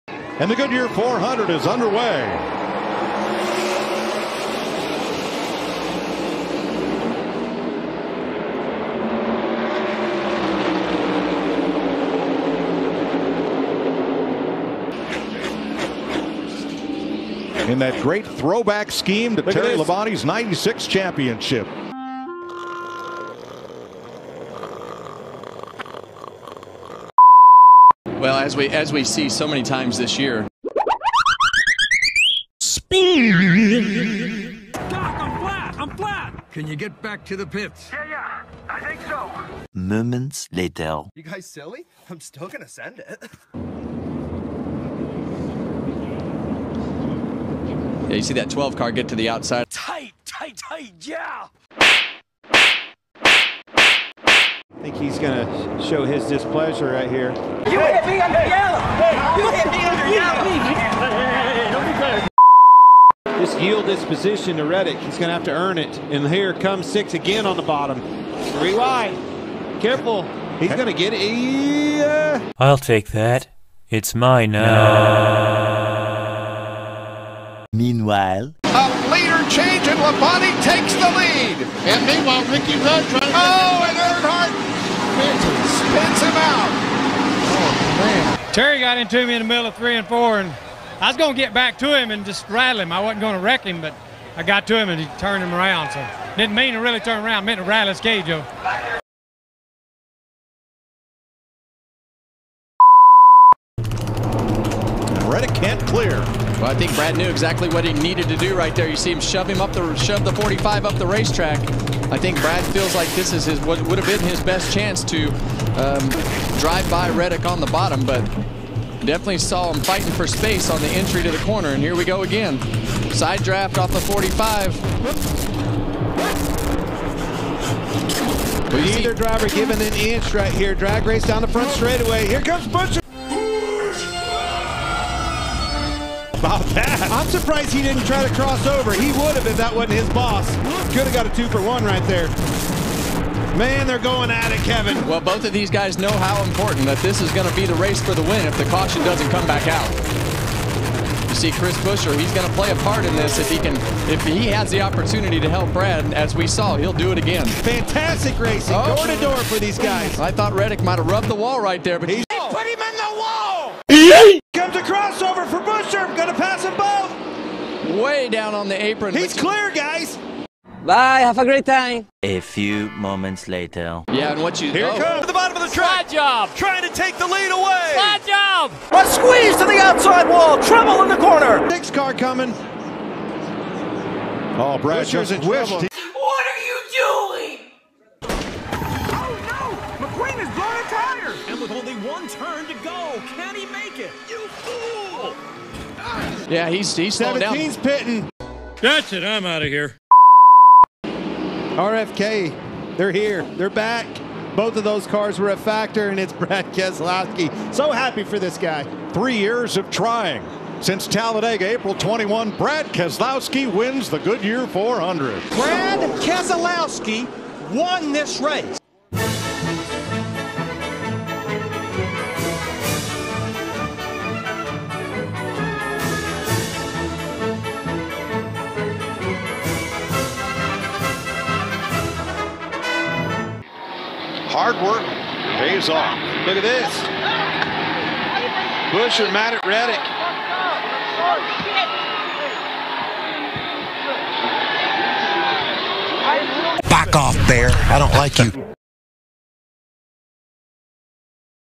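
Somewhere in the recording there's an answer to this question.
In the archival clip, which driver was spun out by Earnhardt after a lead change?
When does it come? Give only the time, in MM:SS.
01:22.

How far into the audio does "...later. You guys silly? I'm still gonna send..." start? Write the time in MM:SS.
00:40.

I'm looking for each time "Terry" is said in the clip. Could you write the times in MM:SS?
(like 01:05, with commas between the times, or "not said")
00:19, 01:28.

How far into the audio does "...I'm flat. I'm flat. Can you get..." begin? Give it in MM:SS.
00:34.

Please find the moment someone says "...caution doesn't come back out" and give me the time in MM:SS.
02:28.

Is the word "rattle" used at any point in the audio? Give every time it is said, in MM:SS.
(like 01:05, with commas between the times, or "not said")
01:32, 01:37.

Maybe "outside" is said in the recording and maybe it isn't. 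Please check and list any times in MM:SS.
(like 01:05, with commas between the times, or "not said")
00:49, 02:59.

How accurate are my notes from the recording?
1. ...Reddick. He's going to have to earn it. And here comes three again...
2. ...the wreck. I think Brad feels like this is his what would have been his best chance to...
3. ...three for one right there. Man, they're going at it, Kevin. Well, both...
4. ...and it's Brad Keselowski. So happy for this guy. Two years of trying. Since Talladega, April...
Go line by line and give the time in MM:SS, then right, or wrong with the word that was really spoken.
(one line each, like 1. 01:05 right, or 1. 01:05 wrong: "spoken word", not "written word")
1. 01:04 wrong: "six", not "three"
2. 01:50 wrong: "racetrack", not "wreck"
3. 02:21 wrong: "two", not "three"
4. 03:26 wrong: "Three", not "Two".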